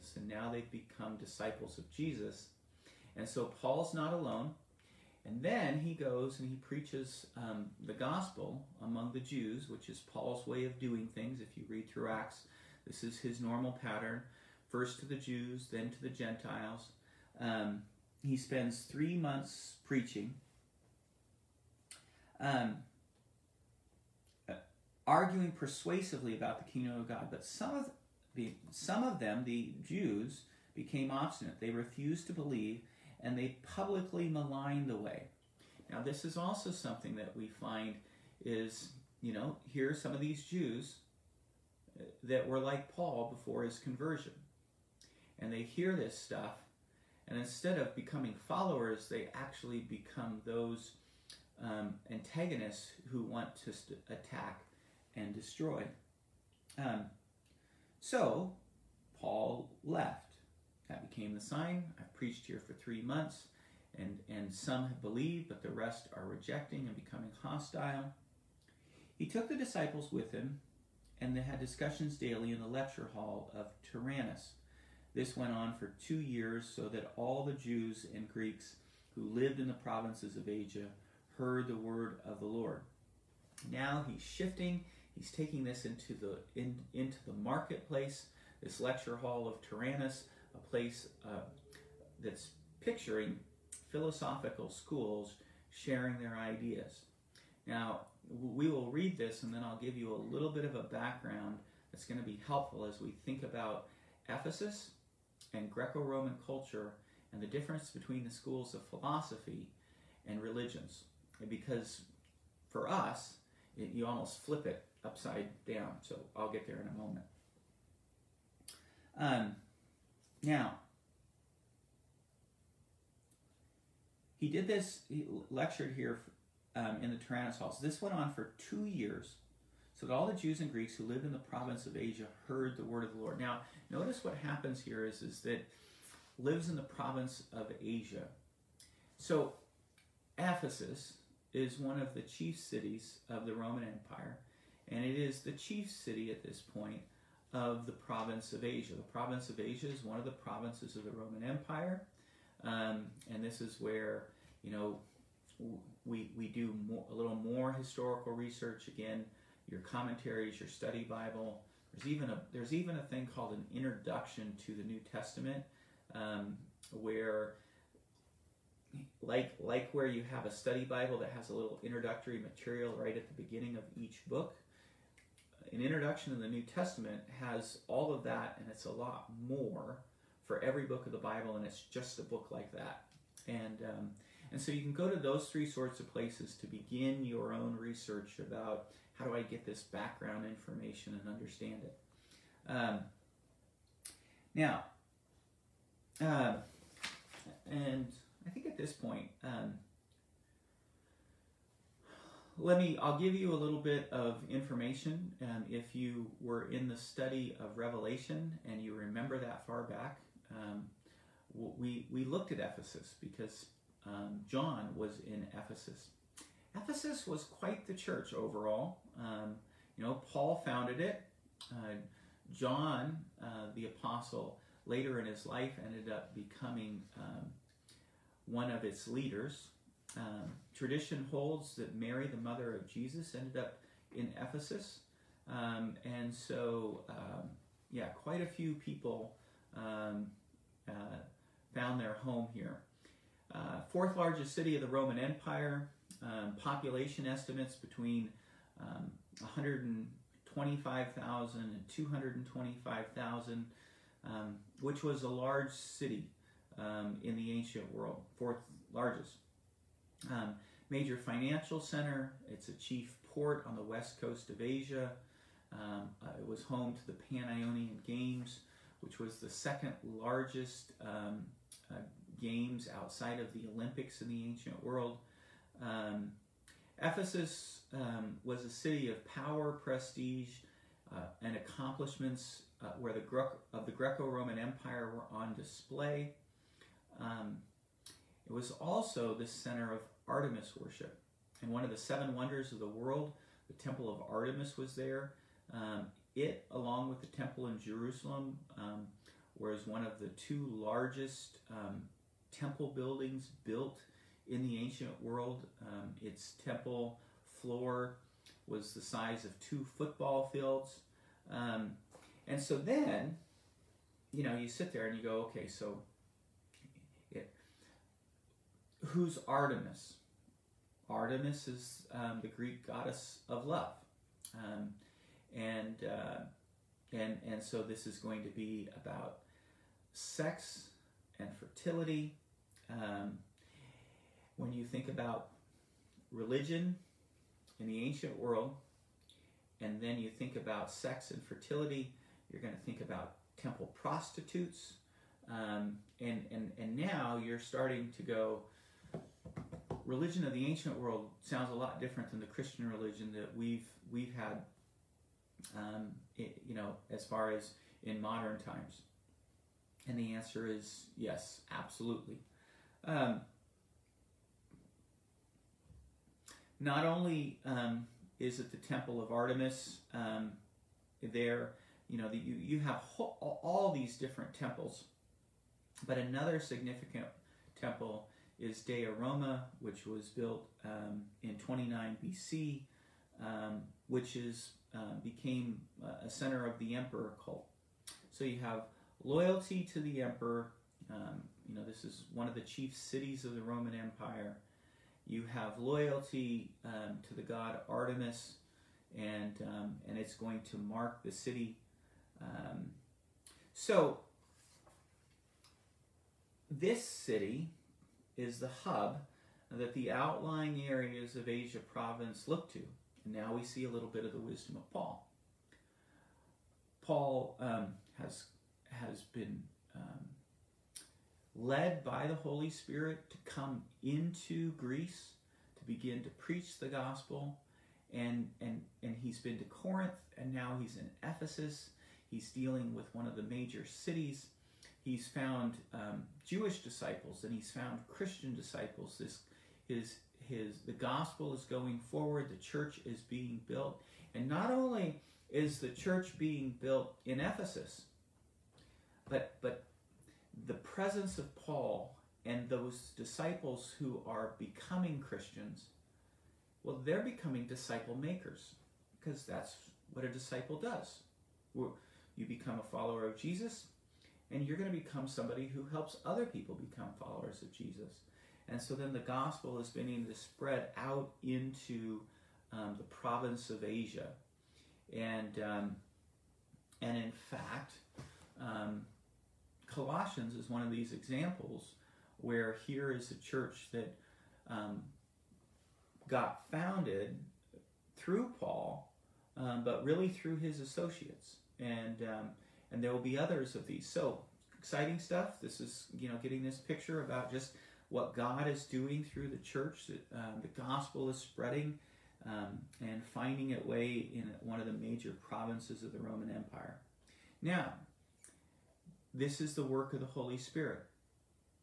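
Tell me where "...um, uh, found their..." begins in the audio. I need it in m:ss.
3:59.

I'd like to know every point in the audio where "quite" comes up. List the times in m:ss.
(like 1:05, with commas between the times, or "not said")
3:37, 3:58.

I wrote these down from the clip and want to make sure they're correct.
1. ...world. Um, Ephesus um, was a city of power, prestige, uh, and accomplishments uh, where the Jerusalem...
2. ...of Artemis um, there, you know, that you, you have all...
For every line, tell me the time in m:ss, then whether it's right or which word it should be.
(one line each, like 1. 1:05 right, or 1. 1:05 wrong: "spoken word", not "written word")
1. 4:34 wrong: "Gre", not "Jerusalem"
2. 6:09 right.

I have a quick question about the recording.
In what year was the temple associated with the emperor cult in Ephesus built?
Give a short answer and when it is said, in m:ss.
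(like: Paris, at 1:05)
29 BC, at 6:21.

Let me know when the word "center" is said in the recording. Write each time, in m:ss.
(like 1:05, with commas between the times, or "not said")
4:21, 4:49, 6:26.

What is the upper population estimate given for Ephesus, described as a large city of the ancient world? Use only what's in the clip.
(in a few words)
225,000.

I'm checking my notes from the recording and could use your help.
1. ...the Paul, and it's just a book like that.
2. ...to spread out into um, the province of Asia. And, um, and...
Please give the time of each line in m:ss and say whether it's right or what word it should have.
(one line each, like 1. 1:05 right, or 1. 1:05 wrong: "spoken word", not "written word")
1. 3:01 wrong: "Bible", not "Paul"
2. 7:50 right.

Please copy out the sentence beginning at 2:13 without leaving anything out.
Now, notice what happens here is, is that lives in the province of Asia.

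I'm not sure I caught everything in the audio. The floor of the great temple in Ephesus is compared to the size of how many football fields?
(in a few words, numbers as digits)
2.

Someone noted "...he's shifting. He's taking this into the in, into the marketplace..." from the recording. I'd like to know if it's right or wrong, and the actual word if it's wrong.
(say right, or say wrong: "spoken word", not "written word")
right.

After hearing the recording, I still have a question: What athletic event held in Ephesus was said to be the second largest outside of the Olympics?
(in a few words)
Pan-Ionian Games.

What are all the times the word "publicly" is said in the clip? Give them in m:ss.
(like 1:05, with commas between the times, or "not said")
0:33.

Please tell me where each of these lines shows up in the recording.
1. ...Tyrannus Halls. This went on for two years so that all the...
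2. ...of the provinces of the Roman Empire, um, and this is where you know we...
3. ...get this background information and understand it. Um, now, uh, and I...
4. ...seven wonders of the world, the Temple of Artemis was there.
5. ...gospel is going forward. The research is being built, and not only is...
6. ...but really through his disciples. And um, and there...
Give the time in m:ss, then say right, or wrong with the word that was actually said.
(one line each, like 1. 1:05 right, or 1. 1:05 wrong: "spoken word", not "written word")
1. 2:07 right
2. 2:30 right
3. 3:09 right
4. 4:51 right
5. 7:20 wrong: "church", not "research"
6. 8:09 wrong: "associates", not "disciples".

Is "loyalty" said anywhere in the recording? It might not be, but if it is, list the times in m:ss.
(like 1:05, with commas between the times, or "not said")
6:29, 6:35.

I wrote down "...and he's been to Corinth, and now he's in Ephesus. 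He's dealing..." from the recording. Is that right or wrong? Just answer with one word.
right.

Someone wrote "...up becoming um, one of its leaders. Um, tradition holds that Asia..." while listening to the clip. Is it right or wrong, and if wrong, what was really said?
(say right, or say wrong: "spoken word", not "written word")
wrong: "Mary", not "Asia".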